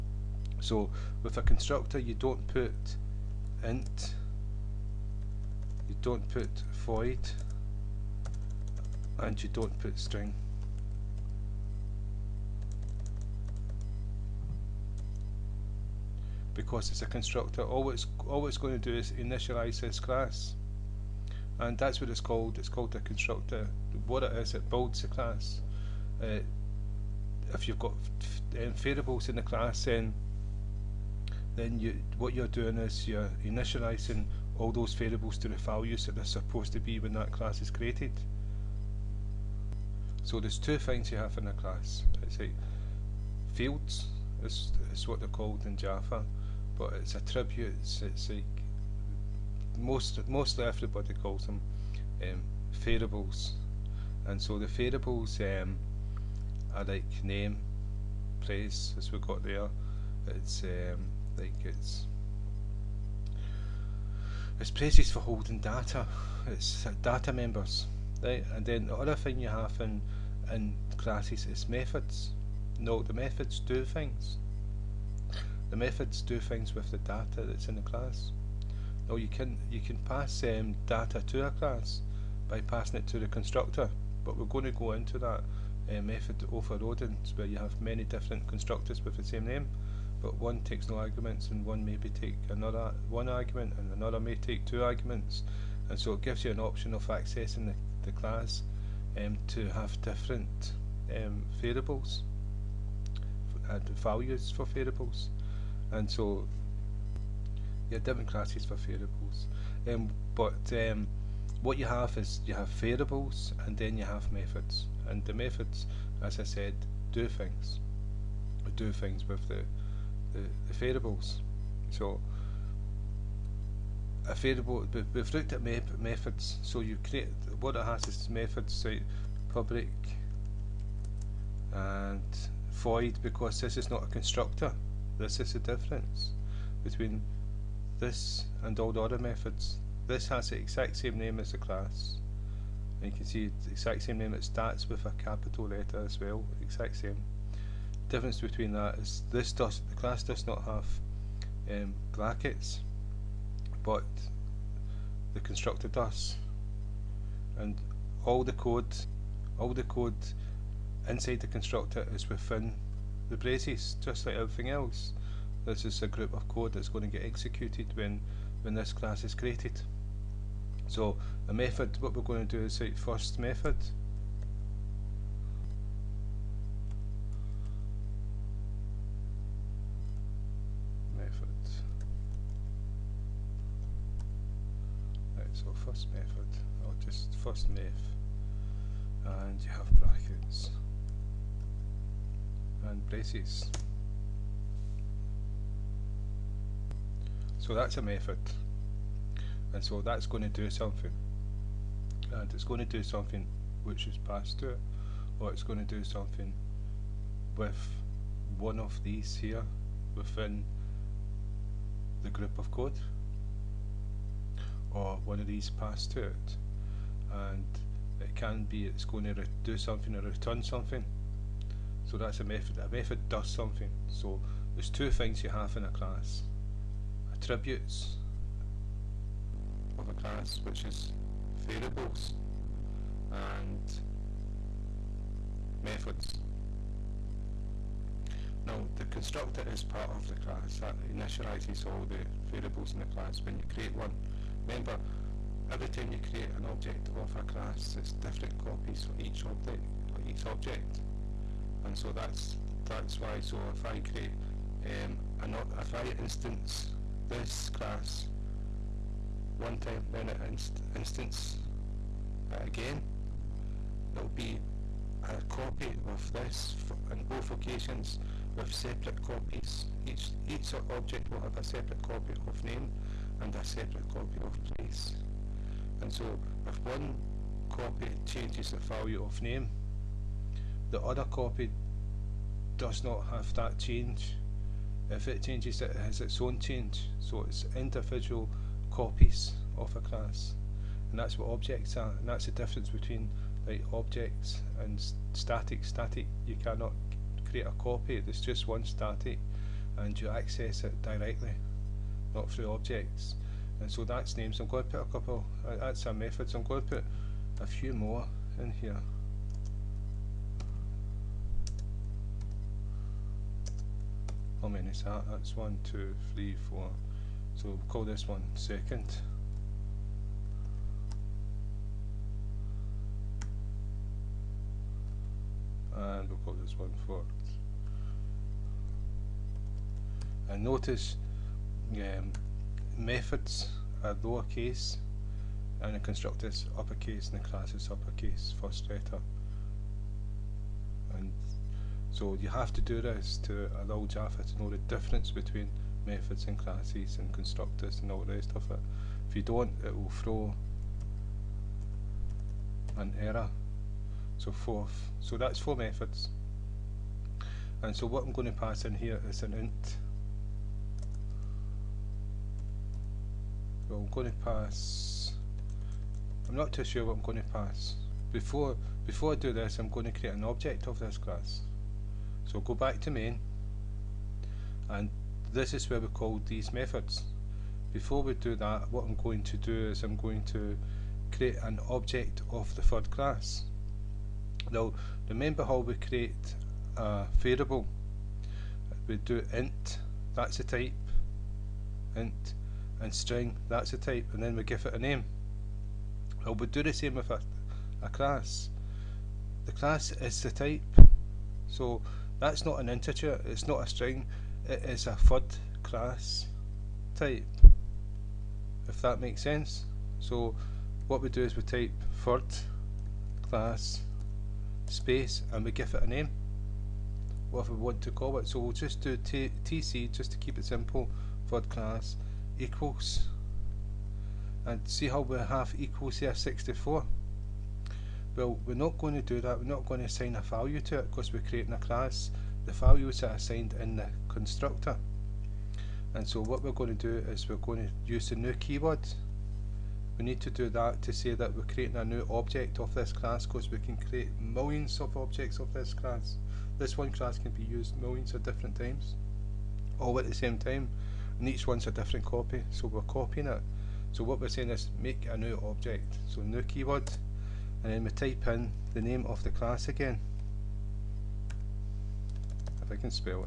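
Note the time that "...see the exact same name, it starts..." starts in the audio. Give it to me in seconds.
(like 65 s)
143 s.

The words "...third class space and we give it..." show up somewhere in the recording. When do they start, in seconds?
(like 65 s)
412 s.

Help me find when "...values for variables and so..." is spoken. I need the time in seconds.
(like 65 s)
103 s.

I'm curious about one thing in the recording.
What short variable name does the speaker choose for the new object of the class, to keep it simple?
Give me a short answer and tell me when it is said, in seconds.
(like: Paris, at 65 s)
TC, at 419 s.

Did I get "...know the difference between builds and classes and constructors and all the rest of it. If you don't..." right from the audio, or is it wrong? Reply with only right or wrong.
wrong.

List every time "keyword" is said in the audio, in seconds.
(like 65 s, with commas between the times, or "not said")
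438 s, 456 s.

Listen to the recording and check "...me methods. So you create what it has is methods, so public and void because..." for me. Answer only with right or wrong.
right.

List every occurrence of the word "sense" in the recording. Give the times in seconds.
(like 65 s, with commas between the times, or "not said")
409 s.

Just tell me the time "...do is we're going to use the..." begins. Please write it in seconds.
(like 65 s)
437 s.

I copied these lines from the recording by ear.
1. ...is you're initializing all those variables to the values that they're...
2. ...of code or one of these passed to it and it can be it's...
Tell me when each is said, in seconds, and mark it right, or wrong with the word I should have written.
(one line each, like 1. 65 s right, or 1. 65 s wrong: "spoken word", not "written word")
1. 32 s right
2. 212 s right.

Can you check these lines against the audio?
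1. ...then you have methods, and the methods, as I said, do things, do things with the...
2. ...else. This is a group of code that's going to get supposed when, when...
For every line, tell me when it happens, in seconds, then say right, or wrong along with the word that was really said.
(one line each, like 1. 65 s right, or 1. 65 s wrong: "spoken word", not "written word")
1. 113 s right
2. 164 s wrong: "executed", not "supposed".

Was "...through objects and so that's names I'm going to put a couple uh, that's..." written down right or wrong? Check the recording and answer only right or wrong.
right.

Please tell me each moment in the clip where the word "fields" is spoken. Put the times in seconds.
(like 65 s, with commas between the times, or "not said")
43 s.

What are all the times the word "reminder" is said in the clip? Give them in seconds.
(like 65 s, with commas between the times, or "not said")
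not said.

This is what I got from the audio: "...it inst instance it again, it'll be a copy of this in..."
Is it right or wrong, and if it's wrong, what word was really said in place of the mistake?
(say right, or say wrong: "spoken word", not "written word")
right.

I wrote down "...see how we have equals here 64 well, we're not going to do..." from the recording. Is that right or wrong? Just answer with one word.
right.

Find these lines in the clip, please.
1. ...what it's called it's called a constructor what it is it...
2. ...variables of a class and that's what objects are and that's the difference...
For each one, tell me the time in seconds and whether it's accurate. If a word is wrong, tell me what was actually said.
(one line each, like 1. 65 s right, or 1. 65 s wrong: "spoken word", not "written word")
1. 22 s right
2. 288 s wrong: "copies", not "variables".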